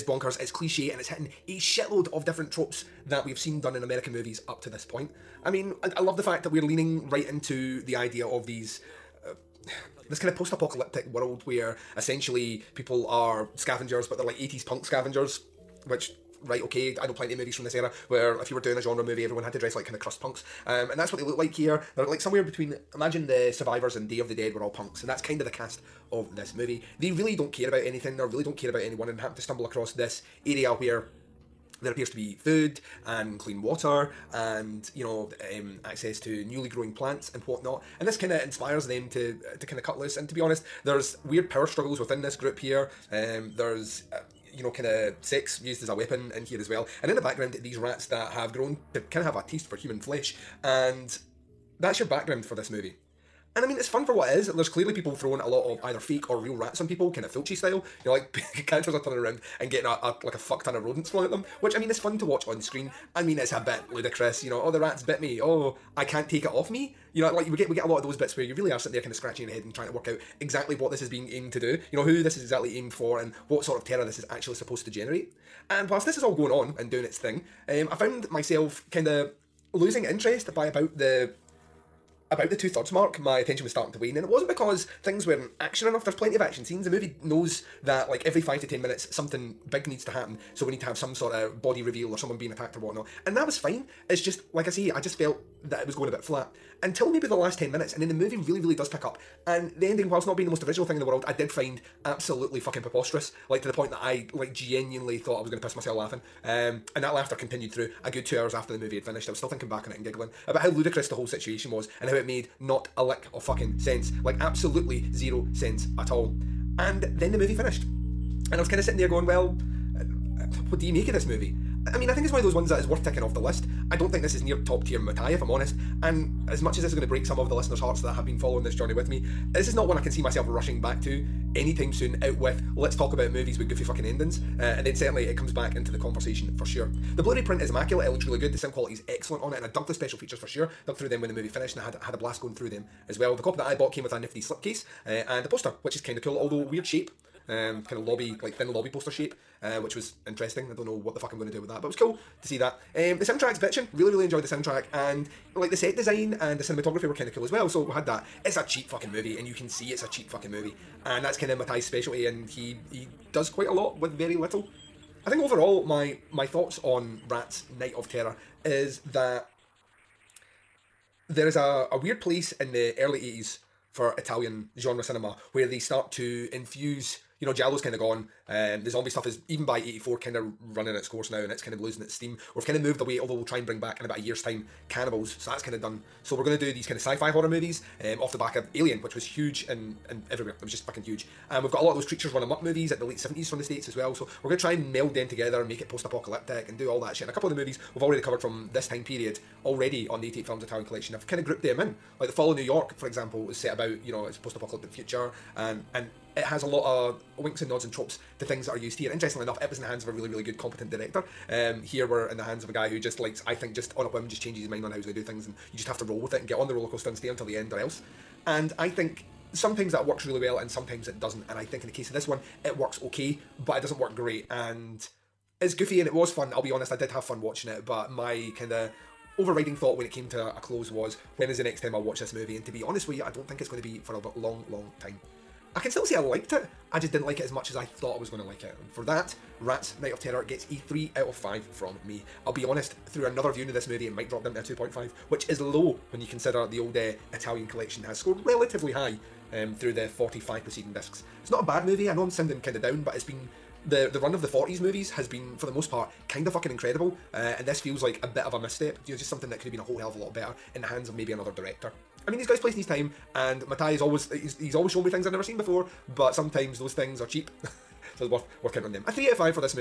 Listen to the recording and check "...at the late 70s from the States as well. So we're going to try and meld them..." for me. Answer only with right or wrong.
right.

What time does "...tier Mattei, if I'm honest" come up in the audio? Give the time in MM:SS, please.
02:04.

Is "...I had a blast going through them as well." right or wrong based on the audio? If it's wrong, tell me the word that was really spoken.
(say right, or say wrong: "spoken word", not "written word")
right.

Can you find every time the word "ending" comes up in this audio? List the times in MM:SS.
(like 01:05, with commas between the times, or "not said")
01:39, 02:14.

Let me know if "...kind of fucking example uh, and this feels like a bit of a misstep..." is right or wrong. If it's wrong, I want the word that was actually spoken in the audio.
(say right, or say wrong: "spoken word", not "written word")
wrong: "incredible", not "example".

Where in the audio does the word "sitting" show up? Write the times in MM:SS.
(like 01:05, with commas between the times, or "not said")
01:08, 01:58.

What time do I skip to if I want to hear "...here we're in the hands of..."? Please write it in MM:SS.
03:31.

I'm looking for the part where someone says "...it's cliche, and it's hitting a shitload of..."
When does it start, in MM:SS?
00:00.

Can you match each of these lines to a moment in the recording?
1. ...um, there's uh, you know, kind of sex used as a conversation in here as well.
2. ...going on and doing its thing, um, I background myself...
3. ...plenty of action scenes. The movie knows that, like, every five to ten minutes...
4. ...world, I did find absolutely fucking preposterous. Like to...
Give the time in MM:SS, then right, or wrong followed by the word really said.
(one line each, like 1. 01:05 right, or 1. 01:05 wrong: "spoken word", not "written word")
1. 00:43 wrong: "weapon", not "conversation"
2. 01:16 wrong: "found", not "background"
3. 01:26 right
4. 01:41 right.